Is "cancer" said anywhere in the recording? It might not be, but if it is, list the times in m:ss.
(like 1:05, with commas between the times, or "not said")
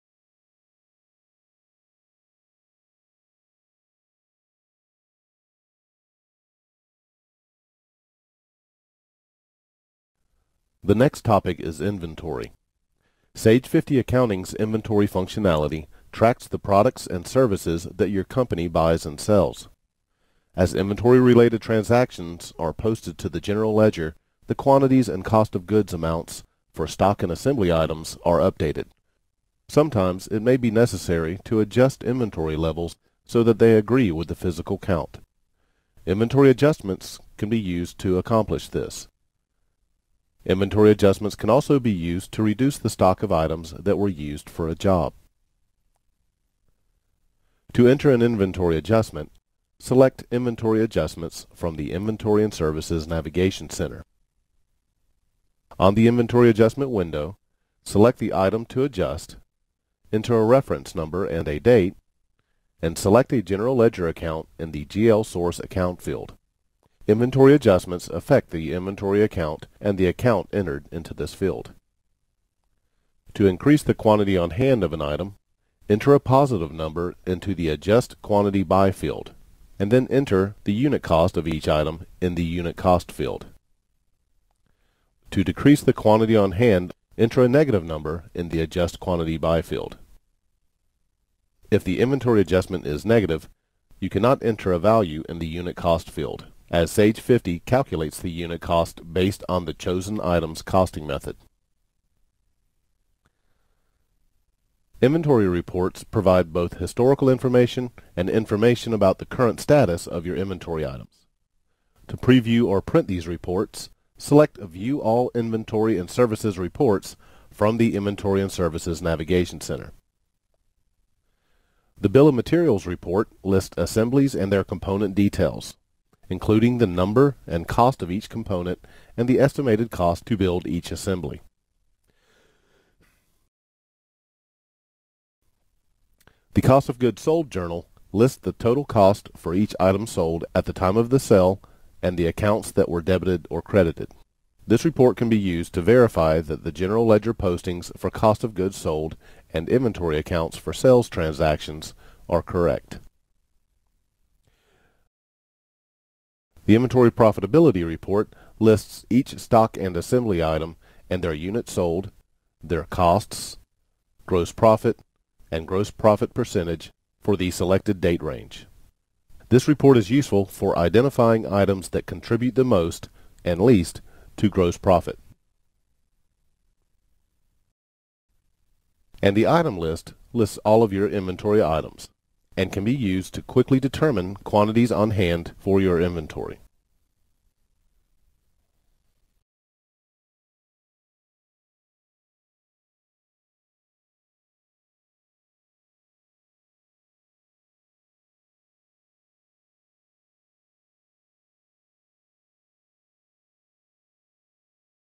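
not said.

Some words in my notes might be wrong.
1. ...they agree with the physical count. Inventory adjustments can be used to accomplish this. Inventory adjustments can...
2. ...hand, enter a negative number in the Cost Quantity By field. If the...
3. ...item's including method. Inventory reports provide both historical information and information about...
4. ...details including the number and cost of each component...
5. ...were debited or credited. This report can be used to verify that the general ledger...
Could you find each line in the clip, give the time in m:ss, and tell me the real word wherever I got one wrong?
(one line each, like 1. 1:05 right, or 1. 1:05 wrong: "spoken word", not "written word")
1. 0:33 right
2. 1:26 wrong: "Adjust", not "Cost"
3. 1:40 wrong: "costing", not "including"
4. 2:05 right
5. 2:22 right.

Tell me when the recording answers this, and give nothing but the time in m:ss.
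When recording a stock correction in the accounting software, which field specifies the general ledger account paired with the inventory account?
1:04.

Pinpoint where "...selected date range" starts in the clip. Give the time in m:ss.
2:47.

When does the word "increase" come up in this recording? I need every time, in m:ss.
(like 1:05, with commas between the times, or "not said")
1:13.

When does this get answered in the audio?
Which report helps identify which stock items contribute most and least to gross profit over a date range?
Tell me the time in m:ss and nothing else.
2:36.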